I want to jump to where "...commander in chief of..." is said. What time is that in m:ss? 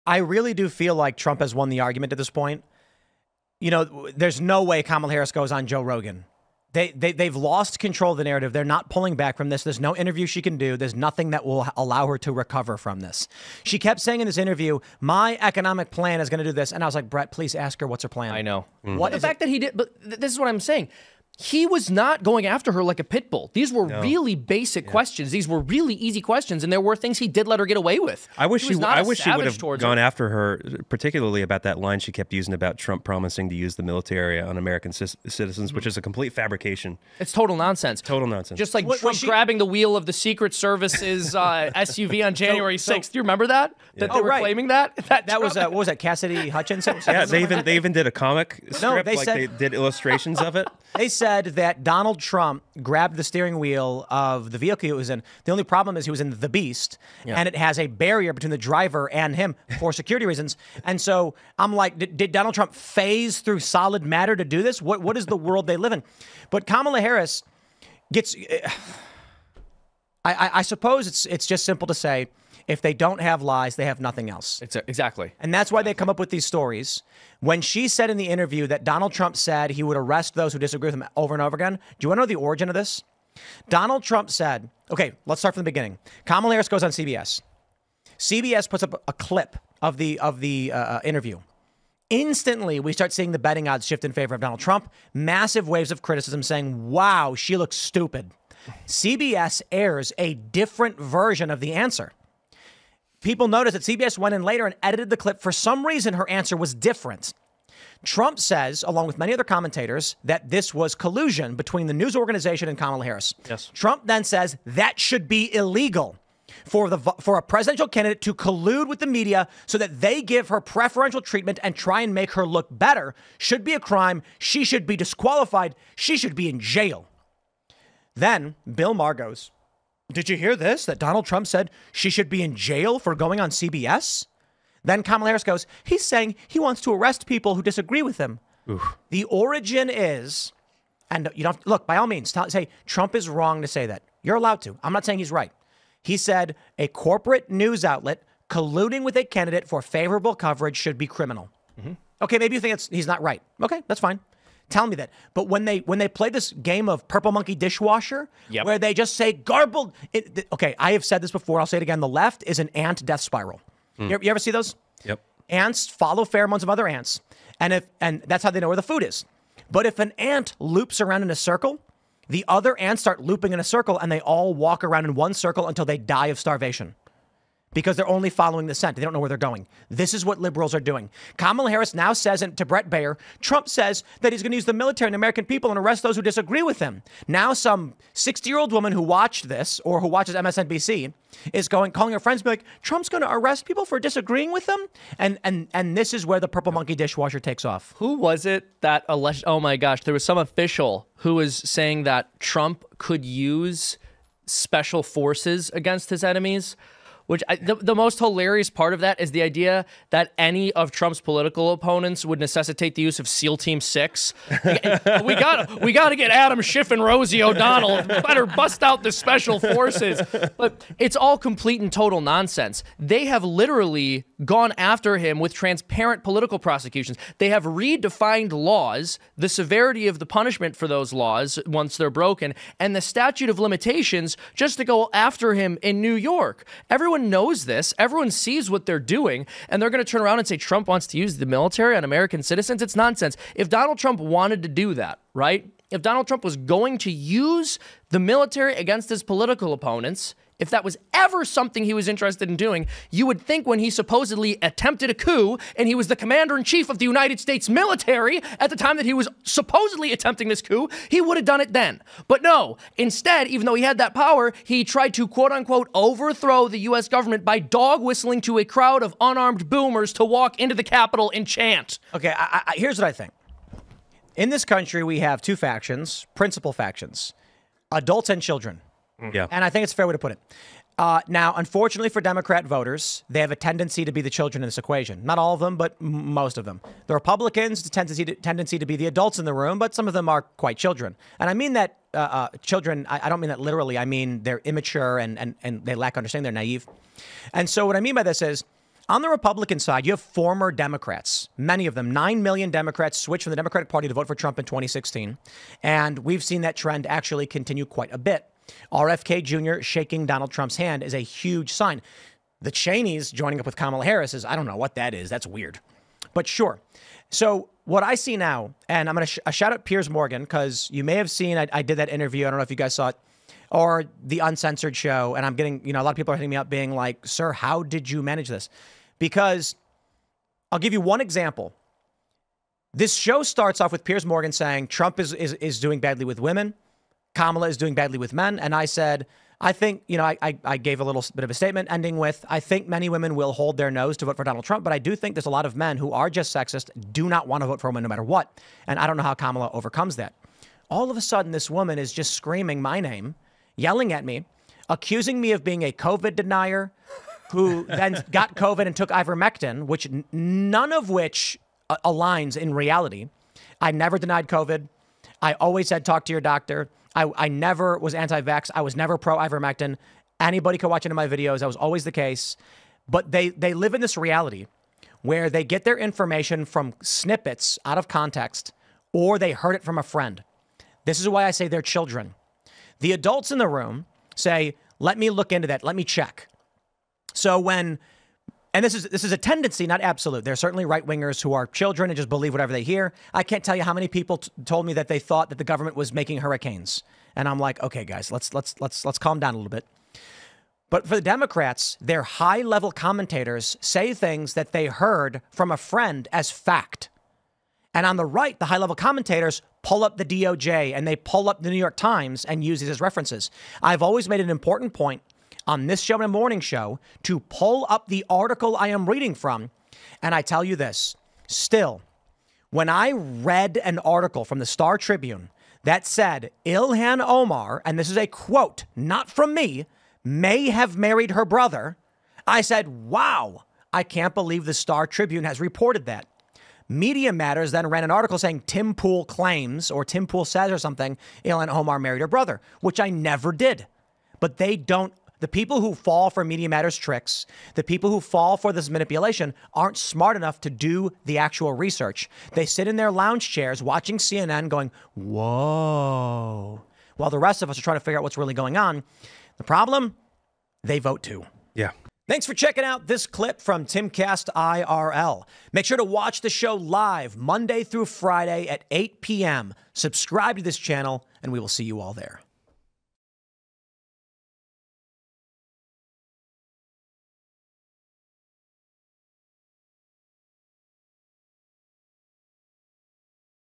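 4:16.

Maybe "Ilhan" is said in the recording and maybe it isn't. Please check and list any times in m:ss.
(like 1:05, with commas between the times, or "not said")
7:06, 7:21.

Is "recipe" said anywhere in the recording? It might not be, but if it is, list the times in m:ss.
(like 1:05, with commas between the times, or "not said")
not said.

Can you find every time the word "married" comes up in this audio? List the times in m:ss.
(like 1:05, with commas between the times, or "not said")
7:10, 7:21.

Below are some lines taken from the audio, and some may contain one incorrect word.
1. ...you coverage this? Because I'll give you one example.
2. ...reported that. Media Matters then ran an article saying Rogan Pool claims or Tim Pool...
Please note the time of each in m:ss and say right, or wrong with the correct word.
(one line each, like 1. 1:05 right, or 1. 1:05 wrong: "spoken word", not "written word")
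1. 5:28 wrong: "manage", not "coverage"
2. 7:15 wrong: "Tim", not "Rogan".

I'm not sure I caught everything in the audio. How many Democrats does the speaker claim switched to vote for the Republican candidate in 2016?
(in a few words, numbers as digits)
9 million.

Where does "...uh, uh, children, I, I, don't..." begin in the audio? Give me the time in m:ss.
4:52.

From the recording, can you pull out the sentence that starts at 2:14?
Then Kamala Harris goes, he's saying he wants to arrest people who disagree with him.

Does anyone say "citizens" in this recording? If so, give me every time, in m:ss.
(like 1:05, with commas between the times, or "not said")
0:34, 4:02.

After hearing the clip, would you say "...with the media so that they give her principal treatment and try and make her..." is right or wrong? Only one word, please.
wrong.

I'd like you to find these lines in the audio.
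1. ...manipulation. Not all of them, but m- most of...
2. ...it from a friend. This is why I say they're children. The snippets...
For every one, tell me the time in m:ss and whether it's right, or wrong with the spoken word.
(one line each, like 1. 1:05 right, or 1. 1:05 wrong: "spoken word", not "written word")
1. 4:44 wrong: "equation", not "manipulation"
2. 6:19 wrong: "adults", not "snippets".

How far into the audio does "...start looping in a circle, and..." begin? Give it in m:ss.
2:53.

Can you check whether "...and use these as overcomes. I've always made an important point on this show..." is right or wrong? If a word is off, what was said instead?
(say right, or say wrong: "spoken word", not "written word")
wrong: "references", not "overcomes".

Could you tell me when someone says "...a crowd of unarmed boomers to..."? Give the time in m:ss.
4:28.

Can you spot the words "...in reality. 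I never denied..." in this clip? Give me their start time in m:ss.
6:02.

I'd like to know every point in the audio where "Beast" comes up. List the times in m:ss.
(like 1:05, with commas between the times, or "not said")
0:56.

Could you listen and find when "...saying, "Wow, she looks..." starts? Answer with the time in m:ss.
1:36.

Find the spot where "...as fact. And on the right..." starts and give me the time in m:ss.
6:46.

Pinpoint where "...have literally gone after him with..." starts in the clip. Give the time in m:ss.
3:43.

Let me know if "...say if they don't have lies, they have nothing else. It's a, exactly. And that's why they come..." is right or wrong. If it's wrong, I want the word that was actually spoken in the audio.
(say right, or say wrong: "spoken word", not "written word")
right.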